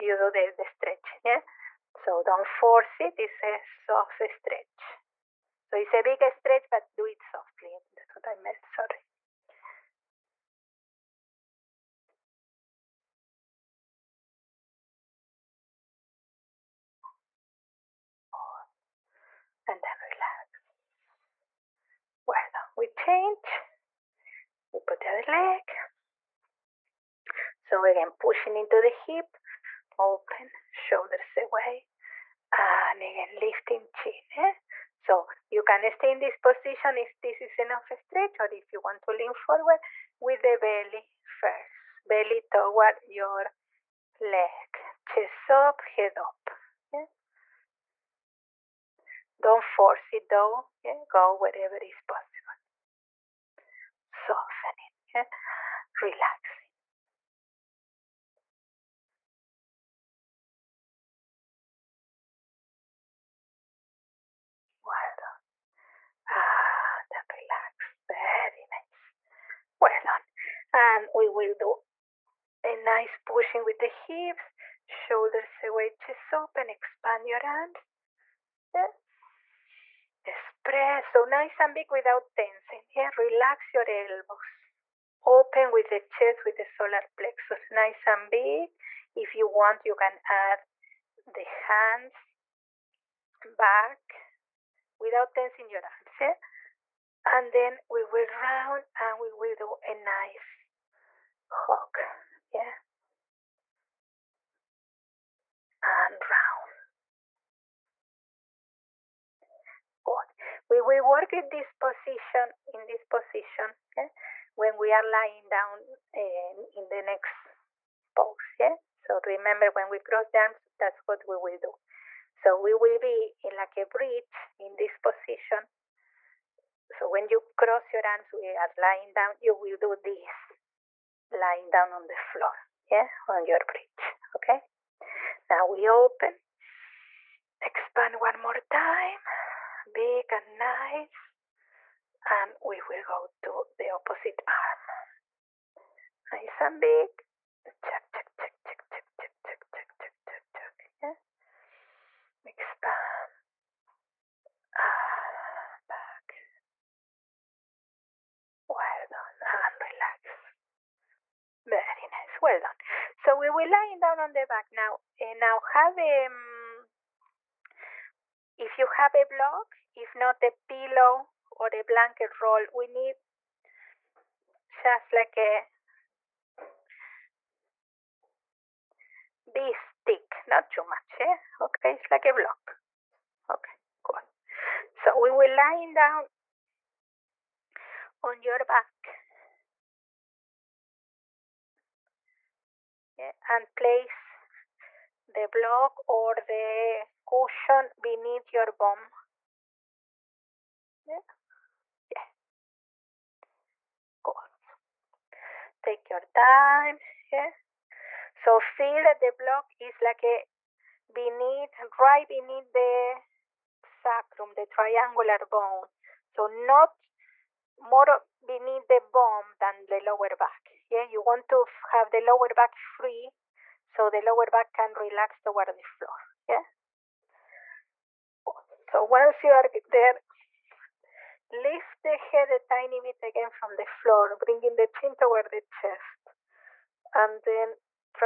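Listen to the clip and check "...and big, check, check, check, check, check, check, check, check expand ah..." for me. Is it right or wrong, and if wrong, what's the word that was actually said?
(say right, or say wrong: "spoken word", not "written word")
right.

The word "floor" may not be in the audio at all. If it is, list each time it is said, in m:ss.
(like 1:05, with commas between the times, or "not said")
2:12, 3:45, 3:53.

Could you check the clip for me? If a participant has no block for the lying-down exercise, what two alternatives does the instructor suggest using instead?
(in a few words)
A pillow or a blanket roll.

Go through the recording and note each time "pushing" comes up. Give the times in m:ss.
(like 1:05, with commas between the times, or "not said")
0:28, 1:13.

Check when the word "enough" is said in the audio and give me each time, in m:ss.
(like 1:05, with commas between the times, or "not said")
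0:37.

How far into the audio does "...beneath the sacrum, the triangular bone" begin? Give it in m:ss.
3:32.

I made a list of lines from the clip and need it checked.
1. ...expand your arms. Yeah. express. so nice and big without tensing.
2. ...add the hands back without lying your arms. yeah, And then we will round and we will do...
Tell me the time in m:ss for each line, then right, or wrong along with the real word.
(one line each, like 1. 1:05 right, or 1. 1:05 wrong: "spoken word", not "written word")
1. 1:16 right
2. 1:30 wrong: "tensing", not "lying".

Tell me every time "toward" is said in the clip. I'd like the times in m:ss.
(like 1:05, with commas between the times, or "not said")
0:42, 3:45, 3:55.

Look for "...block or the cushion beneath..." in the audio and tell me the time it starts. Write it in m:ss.
3:15.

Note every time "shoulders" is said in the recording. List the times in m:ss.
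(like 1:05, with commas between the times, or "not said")
0:30, 1:14.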